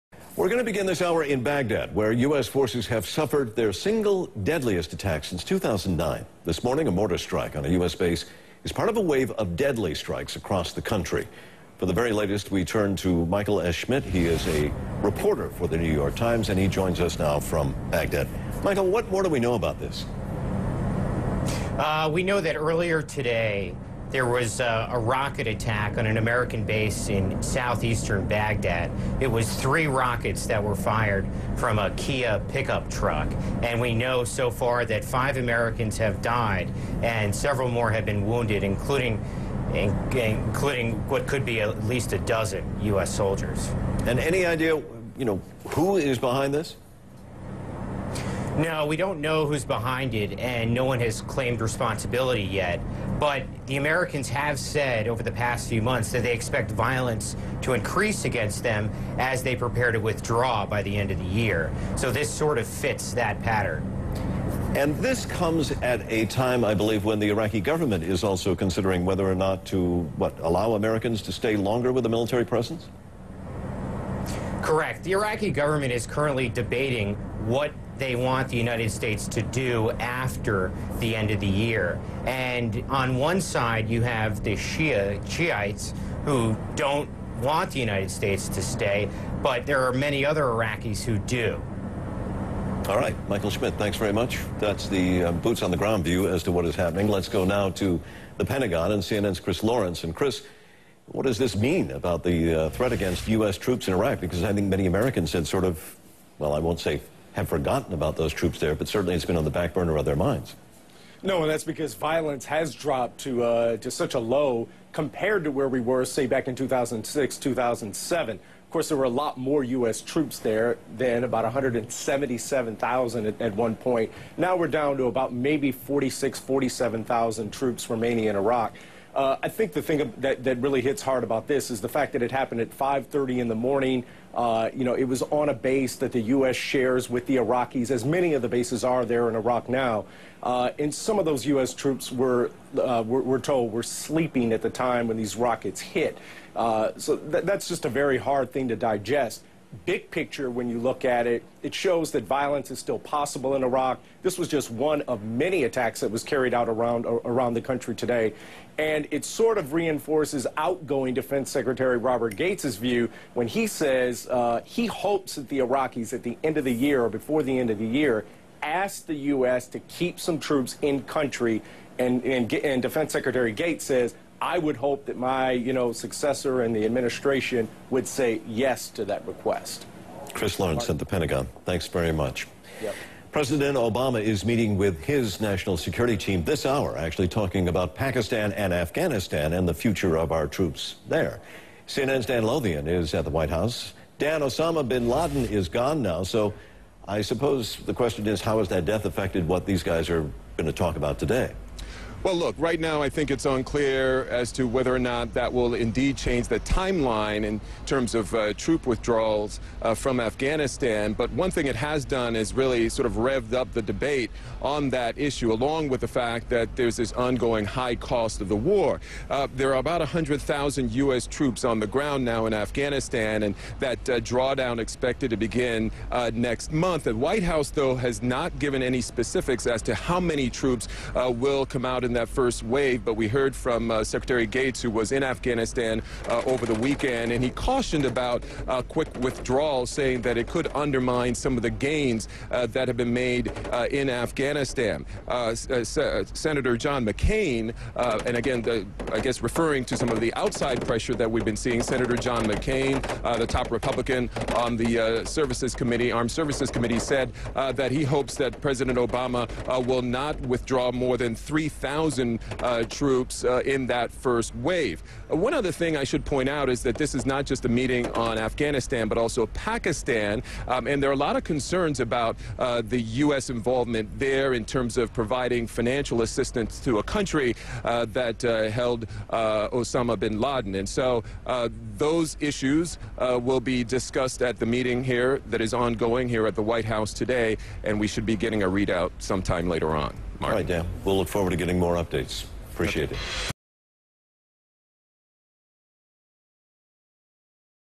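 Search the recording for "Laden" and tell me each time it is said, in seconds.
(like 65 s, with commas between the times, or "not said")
195 s, 280 s.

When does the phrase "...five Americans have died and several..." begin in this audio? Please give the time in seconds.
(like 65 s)
35 s.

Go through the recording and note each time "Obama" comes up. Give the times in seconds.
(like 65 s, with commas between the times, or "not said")
183 s, 258 s.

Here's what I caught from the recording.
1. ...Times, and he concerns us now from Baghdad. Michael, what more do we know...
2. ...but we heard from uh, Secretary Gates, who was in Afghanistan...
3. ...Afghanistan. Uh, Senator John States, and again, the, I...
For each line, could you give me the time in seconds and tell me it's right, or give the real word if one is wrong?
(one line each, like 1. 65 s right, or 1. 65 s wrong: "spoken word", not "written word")
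1. 16 s wrong: "joins", not "concerns"
2. 233 s right
3. 244 s wrong: "McCain", not "States".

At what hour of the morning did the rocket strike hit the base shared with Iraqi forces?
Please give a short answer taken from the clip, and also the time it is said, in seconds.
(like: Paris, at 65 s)
5:30, at 132 s.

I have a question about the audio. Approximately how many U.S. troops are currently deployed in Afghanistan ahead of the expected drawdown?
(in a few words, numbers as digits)
100,000.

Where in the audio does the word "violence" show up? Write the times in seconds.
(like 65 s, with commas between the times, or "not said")
56 s, 111 s, 152 s.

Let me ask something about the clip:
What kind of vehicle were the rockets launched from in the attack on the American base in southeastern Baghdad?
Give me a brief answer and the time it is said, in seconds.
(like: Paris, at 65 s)
Kia pickup truck, at 31 s.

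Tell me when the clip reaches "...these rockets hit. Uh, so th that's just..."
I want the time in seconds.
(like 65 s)
145 s.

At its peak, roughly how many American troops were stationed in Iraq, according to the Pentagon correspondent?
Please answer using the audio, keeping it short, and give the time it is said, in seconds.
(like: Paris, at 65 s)
177,000, at 121 s.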